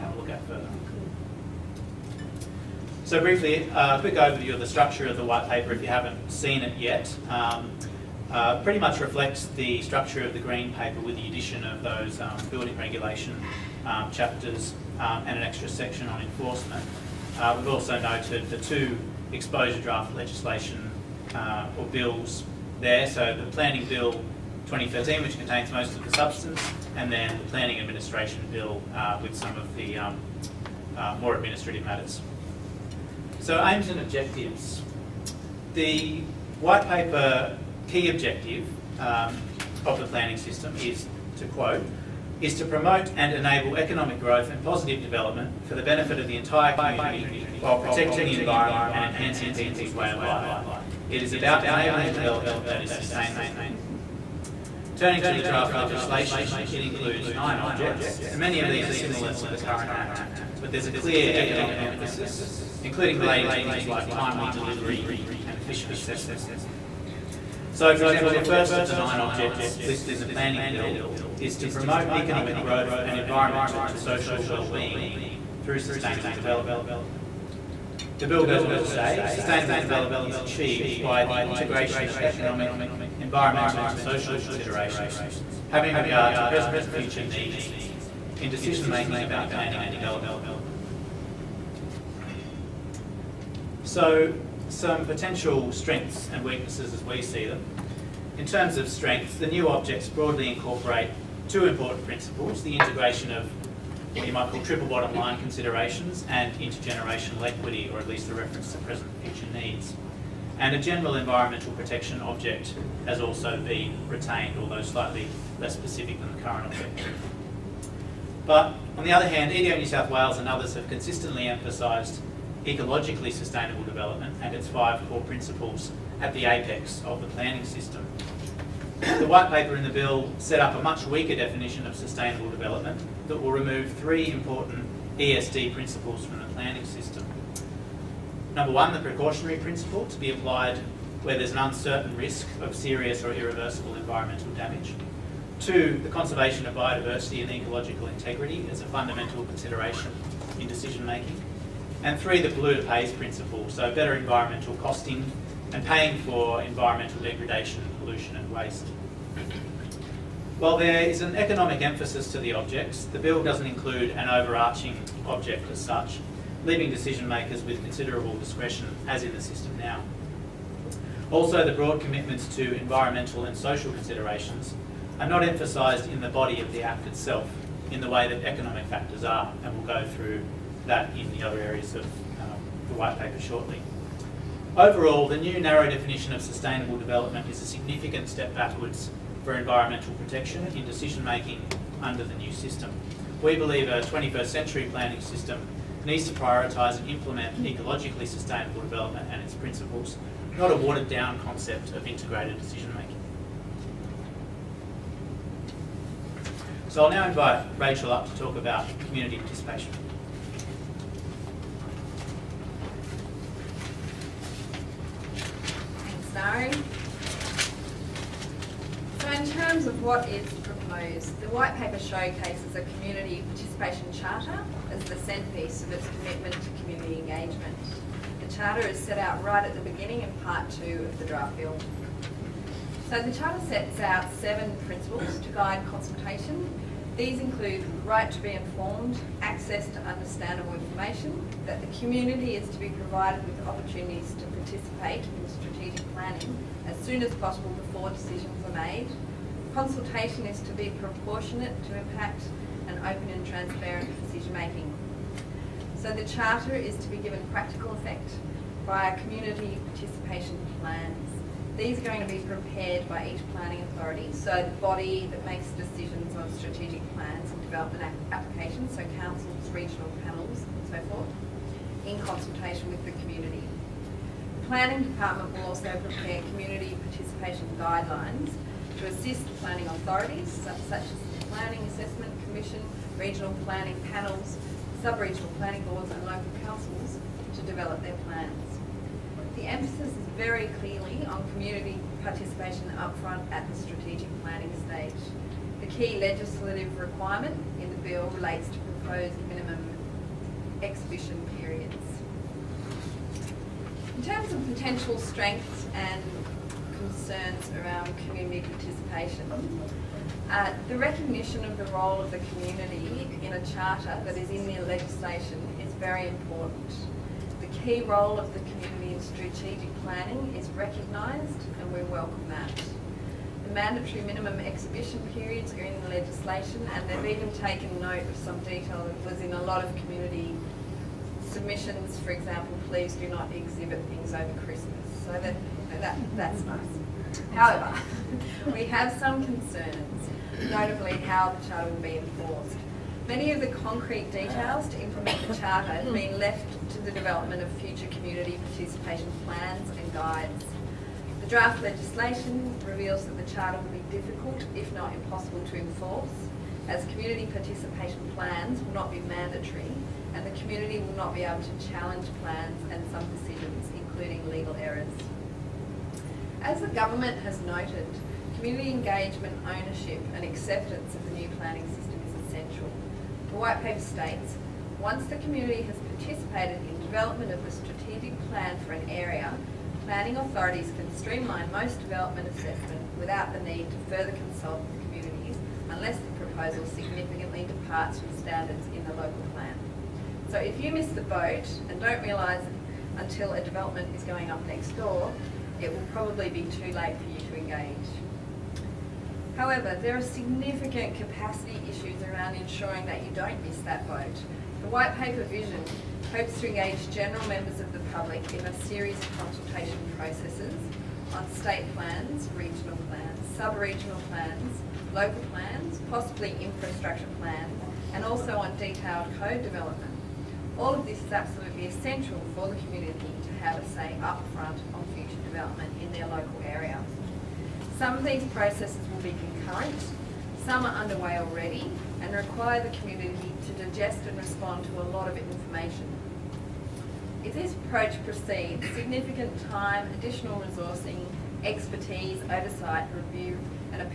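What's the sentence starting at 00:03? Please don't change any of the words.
So briefly, uh, a uh, quick overview of the structure of the white paper if you haven't seen it yet.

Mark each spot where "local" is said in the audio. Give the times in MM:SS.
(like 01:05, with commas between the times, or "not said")
04:46, 06:29, 06:55, 07:06.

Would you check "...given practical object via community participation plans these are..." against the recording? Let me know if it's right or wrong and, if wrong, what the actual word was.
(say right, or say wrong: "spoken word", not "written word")
wrong: "effect", not "object".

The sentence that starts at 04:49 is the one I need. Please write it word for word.
The emphasis is very clearly on community participation up front at the strategic planning stage.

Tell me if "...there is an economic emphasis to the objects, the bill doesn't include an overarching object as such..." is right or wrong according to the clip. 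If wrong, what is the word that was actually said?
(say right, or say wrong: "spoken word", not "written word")
right.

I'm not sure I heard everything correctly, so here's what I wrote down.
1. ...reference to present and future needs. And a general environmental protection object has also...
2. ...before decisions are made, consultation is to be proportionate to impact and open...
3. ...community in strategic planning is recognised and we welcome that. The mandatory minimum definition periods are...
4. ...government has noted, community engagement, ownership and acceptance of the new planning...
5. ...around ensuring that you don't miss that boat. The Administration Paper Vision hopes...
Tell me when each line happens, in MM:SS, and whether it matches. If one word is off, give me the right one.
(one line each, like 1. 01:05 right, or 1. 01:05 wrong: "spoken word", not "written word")
1. 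01:48 right
2. 04:07 right
3. 05:18 wrong: "exhibition", not "definition"
4. 06:06 right
5. 06:42 wrong: "White", not "Administration".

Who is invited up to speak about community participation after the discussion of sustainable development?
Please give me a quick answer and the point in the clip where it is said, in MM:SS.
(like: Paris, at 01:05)
Rachel, at 03:27.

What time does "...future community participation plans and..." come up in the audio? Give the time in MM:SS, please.
05:47.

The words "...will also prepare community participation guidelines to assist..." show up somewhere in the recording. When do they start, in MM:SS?
04:35.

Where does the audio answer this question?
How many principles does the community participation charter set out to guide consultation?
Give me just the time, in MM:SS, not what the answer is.
03:54.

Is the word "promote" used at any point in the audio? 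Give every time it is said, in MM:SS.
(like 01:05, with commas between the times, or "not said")
00:42, 01:11.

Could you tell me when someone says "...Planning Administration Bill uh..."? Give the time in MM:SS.
00:27.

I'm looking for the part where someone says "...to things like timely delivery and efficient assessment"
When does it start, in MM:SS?
01:03.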